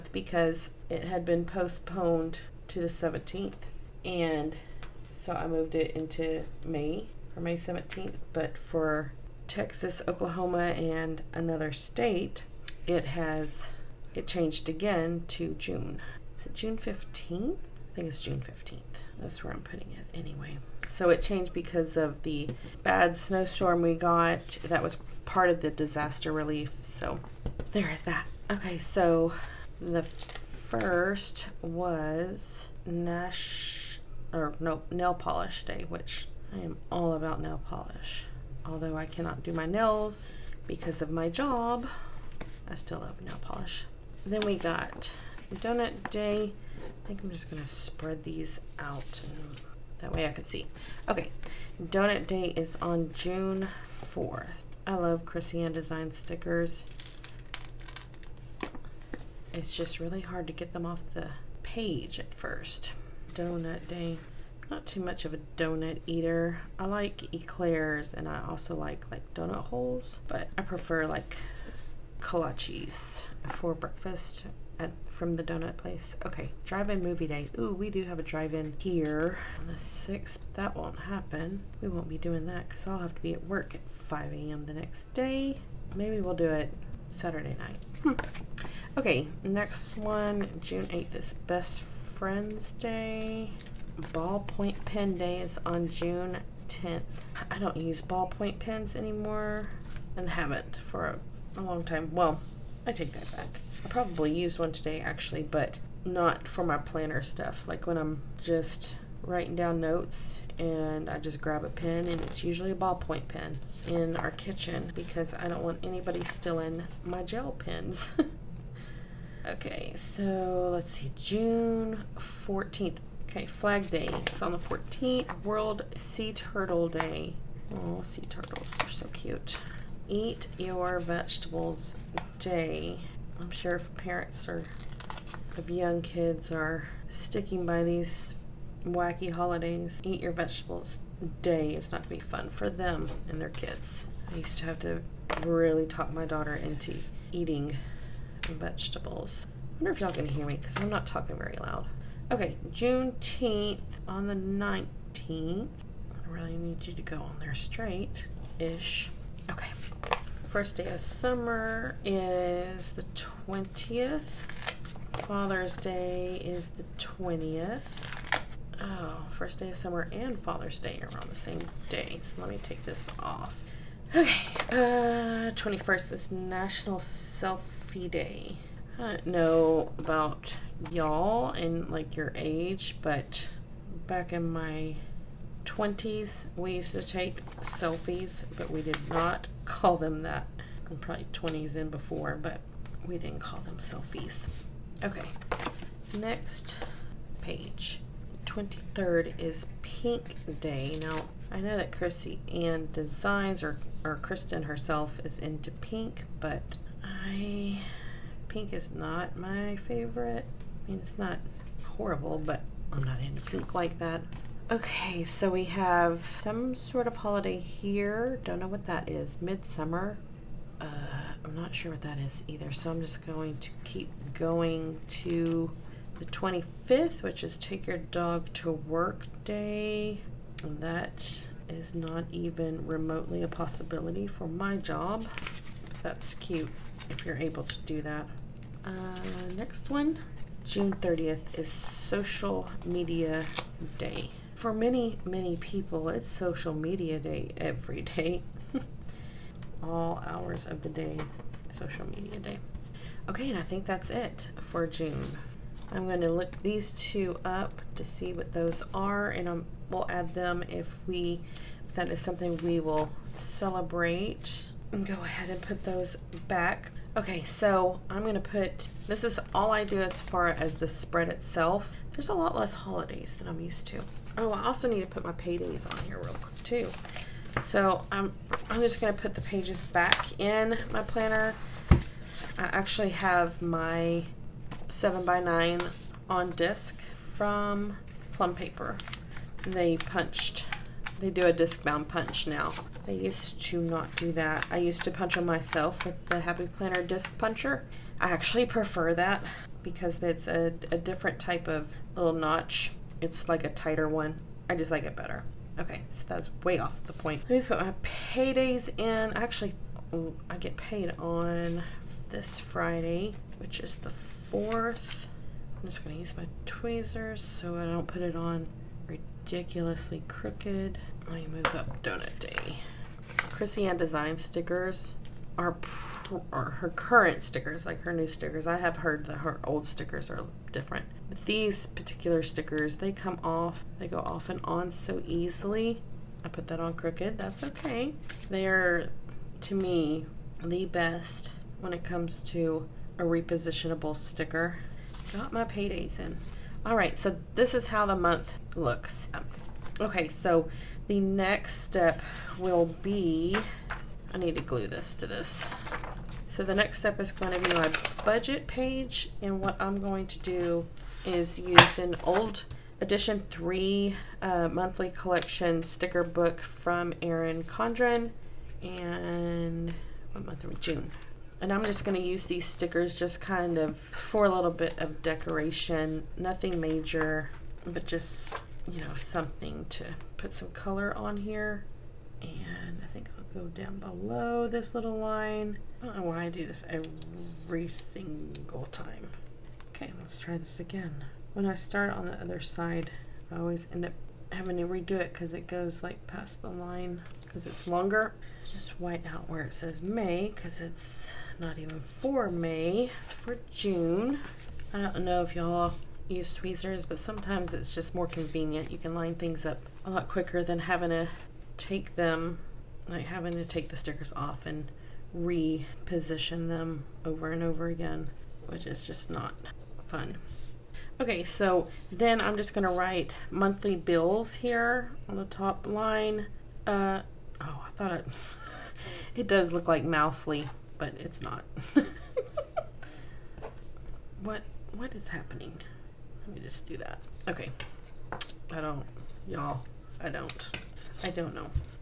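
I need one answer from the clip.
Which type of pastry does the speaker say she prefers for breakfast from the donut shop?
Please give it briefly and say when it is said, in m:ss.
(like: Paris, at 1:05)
kolaches, at 1:12.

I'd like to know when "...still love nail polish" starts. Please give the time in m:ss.
0:42.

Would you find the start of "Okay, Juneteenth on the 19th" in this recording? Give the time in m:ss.
2:32.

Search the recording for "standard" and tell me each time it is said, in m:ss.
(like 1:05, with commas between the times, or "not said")
not said.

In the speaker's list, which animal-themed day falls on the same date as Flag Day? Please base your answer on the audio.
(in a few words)
World Sea Turtle Day.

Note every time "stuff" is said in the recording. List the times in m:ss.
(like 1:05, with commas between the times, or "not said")
1:47.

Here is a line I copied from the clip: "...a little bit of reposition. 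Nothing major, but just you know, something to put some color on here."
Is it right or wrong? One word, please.
wrong.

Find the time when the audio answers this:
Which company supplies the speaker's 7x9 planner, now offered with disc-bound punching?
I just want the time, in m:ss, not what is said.
4:48.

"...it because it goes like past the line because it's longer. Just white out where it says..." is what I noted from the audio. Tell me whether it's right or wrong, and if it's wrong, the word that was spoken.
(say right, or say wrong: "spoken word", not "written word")
right.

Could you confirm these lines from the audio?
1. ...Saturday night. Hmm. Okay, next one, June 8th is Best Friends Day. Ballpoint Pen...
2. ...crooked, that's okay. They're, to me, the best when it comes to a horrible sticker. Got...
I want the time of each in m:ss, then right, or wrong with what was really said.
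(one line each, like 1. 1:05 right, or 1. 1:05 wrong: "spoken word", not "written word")
1. 1:27 right
2. 5:36 wrong: "repositionable", not "horrible".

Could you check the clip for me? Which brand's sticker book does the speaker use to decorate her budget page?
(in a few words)
Erin Condren.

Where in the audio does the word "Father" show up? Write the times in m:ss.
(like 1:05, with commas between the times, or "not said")
2:45, 2:50.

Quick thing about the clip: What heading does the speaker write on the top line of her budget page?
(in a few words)
monthly bills.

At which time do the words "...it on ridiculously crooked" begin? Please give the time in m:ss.
5:18.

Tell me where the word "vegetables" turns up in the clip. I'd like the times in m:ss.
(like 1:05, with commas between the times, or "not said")
2:10, 2:20, 2:28.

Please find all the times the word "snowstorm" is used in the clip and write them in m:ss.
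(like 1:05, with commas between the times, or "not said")
0:23.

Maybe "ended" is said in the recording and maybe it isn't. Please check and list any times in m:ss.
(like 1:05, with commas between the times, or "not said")
not said.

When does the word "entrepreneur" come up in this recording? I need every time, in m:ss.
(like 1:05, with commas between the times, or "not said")
not said.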